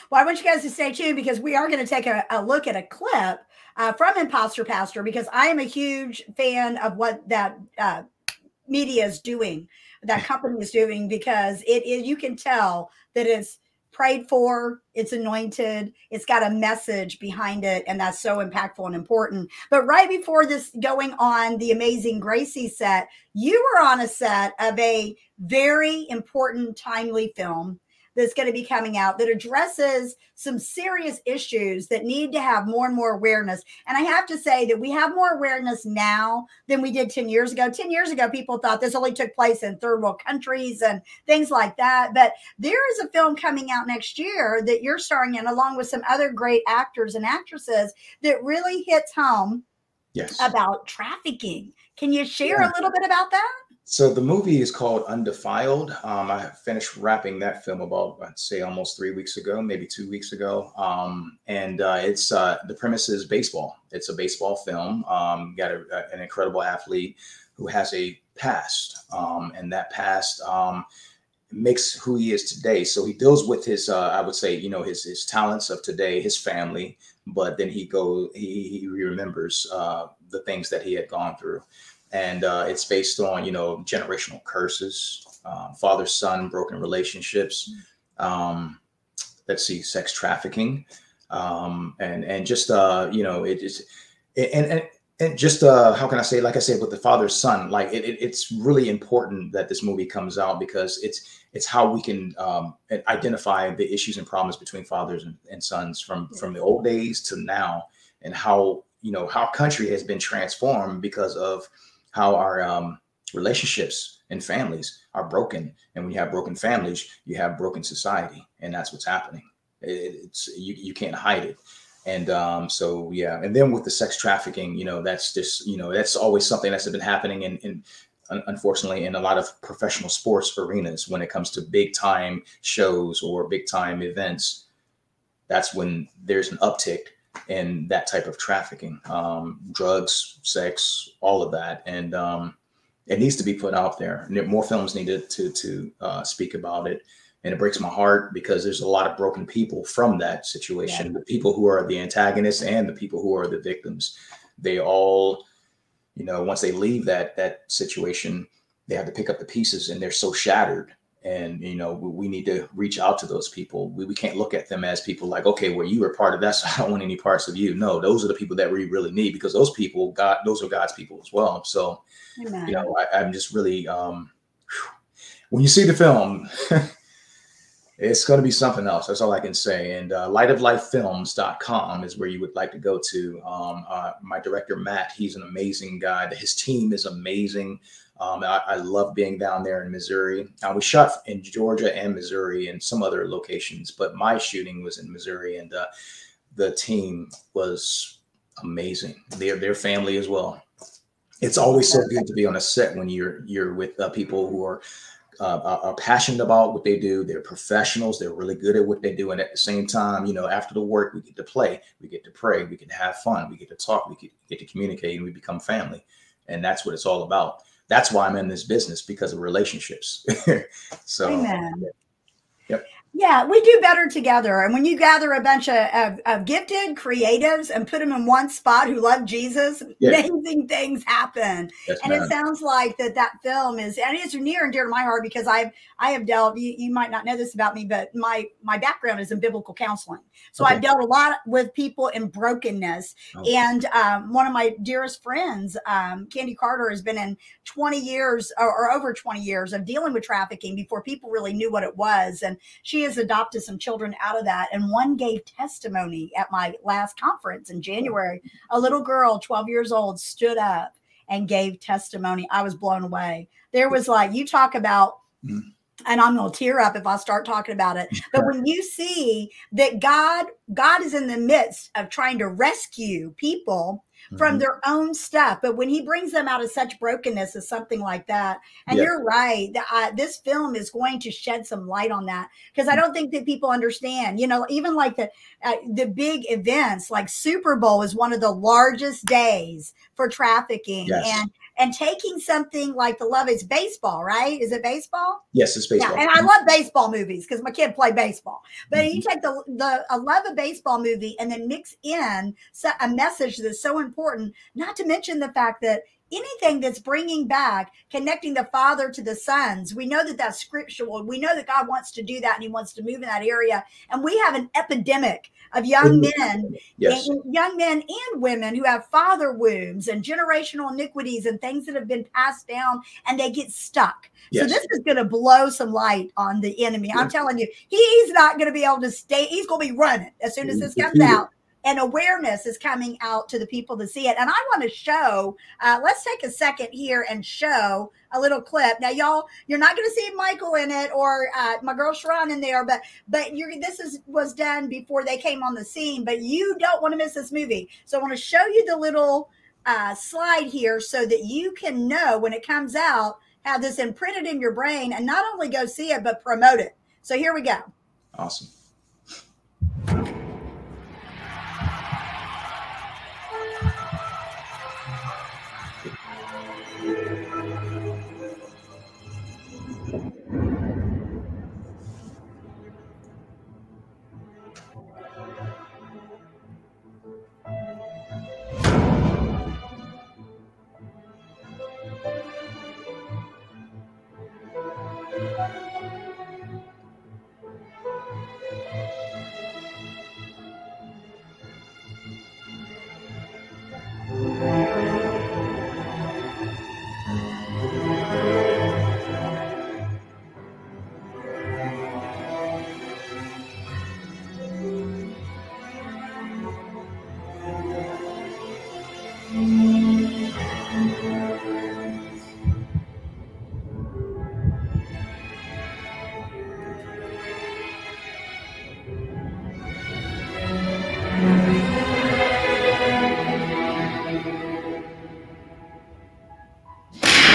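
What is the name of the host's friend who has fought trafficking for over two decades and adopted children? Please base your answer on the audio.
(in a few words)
Candy Carter.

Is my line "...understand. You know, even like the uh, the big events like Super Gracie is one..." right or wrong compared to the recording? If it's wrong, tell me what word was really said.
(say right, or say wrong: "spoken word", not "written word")
wrong: "Bowl", not "Gracie".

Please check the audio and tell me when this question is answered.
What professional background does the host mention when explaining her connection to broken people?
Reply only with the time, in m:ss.
3:59.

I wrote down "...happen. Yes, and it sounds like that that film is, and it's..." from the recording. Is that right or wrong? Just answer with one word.
right.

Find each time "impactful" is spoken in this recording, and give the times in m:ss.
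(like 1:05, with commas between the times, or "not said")
0:18.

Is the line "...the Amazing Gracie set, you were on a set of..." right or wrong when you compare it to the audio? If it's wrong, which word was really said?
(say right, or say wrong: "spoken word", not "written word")
right.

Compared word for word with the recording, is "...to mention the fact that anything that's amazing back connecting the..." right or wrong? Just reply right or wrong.
wrong.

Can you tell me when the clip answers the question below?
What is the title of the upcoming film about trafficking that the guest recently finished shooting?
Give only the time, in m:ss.
0:55.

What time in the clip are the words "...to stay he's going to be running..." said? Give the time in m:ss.
5:28.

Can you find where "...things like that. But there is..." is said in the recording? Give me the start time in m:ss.
0:41.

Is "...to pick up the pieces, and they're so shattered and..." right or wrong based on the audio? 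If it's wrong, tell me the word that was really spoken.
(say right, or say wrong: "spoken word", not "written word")
right.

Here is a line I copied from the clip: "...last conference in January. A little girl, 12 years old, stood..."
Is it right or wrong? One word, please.
right.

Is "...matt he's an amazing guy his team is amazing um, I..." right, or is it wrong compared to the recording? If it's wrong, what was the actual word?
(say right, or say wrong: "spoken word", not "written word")
right.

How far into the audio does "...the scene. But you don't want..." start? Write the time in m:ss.
5:45.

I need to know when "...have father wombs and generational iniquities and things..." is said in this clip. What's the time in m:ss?
5:18.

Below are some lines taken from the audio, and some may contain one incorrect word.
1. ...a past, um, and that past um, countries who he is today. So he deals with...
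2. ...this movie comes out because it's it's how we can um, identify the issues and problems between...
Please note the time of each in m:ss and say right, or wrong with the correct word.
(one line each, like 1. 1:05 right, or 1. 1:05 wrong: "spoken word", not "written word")
1. 1:07 wrong: "makes", not "countries"
2. 1:39 right.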